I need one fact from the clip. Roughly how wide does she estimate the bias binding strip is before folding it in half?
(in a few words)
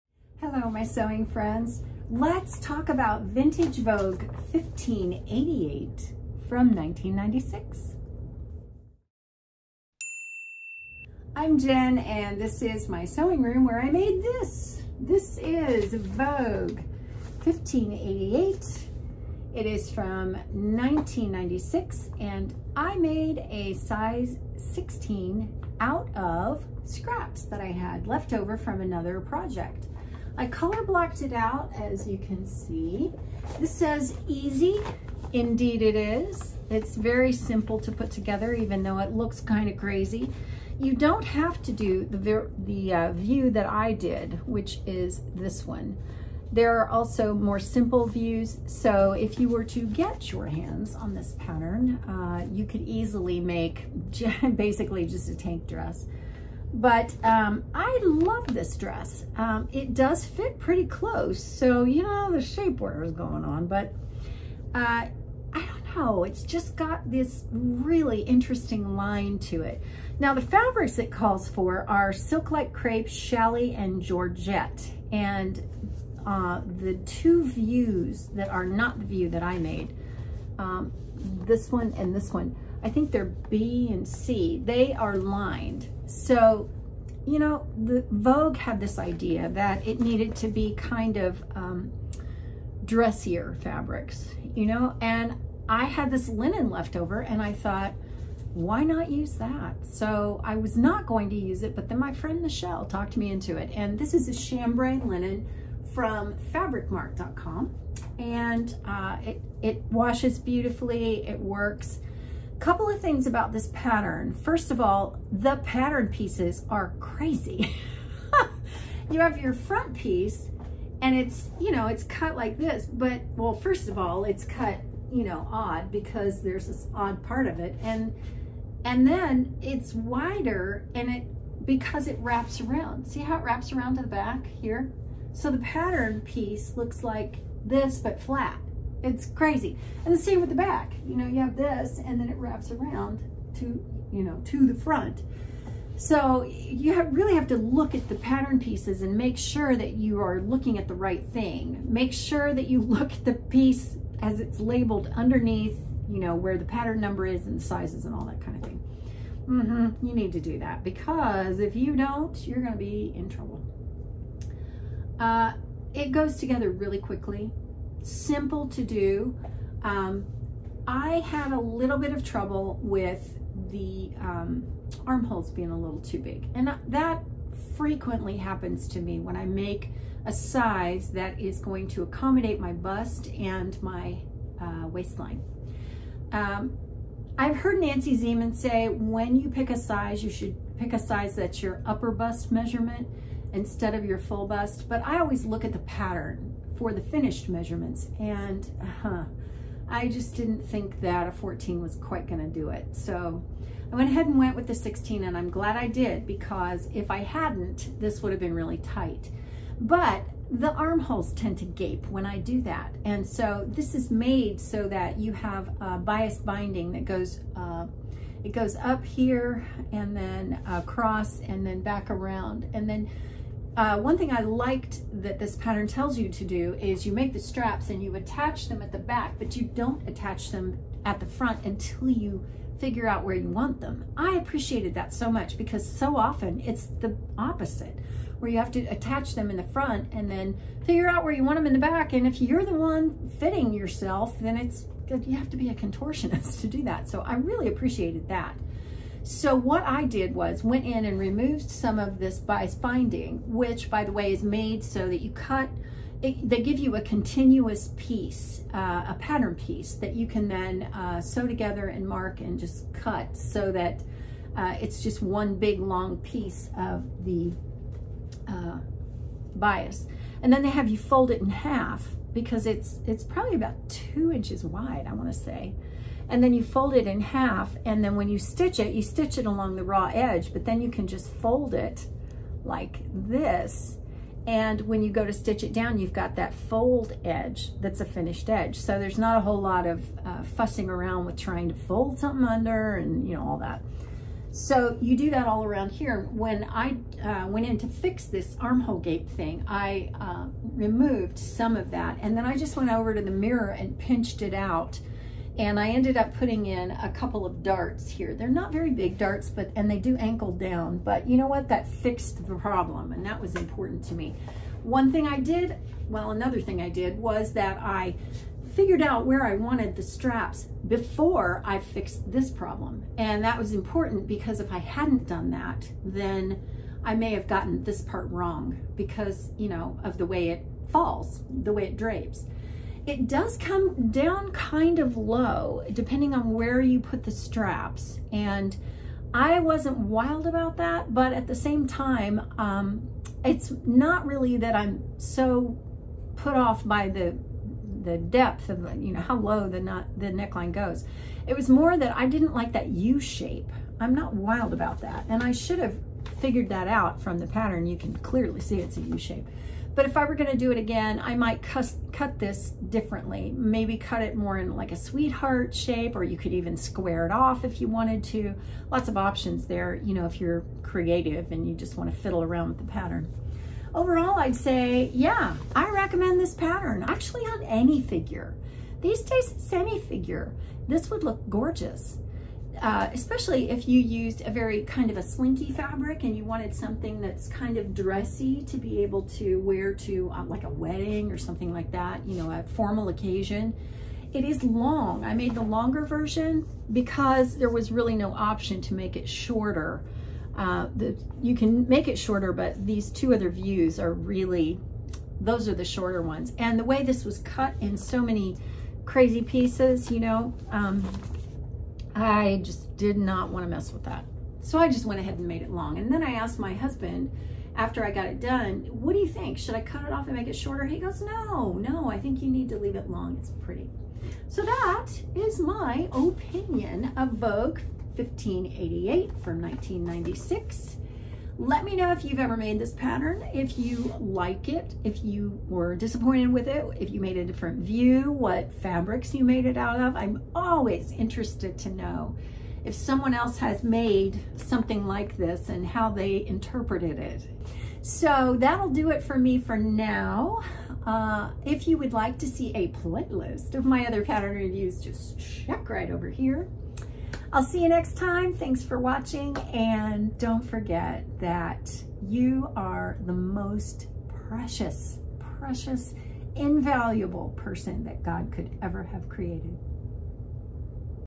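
2 inches.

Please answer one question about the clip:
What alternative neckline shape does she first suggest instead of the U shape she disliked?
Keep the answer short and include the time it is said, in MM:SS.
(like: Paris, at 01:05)
Sweetheart, at 06:04.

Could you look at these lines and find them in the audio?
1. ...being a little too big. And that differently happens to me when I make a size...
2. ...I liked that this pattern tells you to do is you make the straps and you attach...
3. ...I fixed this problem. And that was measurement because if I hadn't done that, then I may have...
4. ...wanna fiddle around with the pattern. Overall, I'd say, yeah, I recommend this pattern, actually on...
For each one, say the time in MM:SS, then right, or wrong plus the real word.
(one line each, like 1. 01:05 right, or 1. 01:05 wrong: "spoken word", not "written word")
1. 02:55 wrong: "frequently", not "differently"
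2. 03:44 right
3. 05:21 wrong: "important", not "measurement"
4. 06:11 right.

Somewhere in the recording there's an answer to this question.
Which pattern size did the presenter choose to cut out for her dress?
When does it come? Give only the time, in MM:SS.
00:23.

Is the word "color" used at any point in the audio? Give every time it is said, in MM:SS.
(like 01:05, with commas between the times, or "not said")
00:30.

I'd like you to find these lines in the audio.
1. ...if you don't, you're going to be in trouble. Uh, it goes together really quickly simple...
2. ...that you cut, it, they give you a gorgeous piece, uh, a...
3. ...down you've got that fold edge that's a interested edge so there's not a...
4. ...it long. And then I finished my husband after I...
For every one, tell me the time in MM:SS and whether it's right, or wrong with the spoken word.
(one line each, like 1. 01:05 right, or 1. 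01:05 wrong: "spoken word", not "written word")
1. 02:41 right
2. 04:15 wrong: "continuous", not "gorgeous"
3. 04:45 wrong: "finished", not "interested"
4. 06:55 wrong: "asked", not "finished".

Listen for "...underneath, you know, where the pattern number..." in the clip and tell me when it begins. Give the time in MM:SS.
02:35.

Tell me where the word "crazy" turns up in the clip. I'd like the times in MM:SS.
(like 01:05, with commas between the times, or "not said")
00:39, 01:56, 02:19, 06:49.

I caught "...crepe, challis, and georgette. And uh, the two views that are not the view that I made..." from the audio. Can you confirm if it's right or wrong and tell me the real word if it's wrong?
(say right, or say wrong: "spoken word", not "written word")
right.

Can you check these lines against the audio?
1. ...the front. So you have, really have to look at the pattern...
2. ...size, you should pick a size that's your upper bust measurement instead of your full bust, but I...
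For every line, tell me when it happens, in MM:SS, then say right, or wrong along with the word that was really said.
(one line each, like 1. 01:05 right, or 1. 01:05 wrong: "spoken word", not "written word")
1. 02:24 right
2. 03:09 right.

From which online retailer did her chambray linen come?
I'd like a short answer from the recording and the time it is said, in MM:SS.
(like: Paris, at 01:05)
fabricmark.com, at 01:46.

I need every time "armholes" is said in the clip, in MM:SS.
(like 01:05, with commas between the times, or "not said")
02:55, 03:30, 04:58.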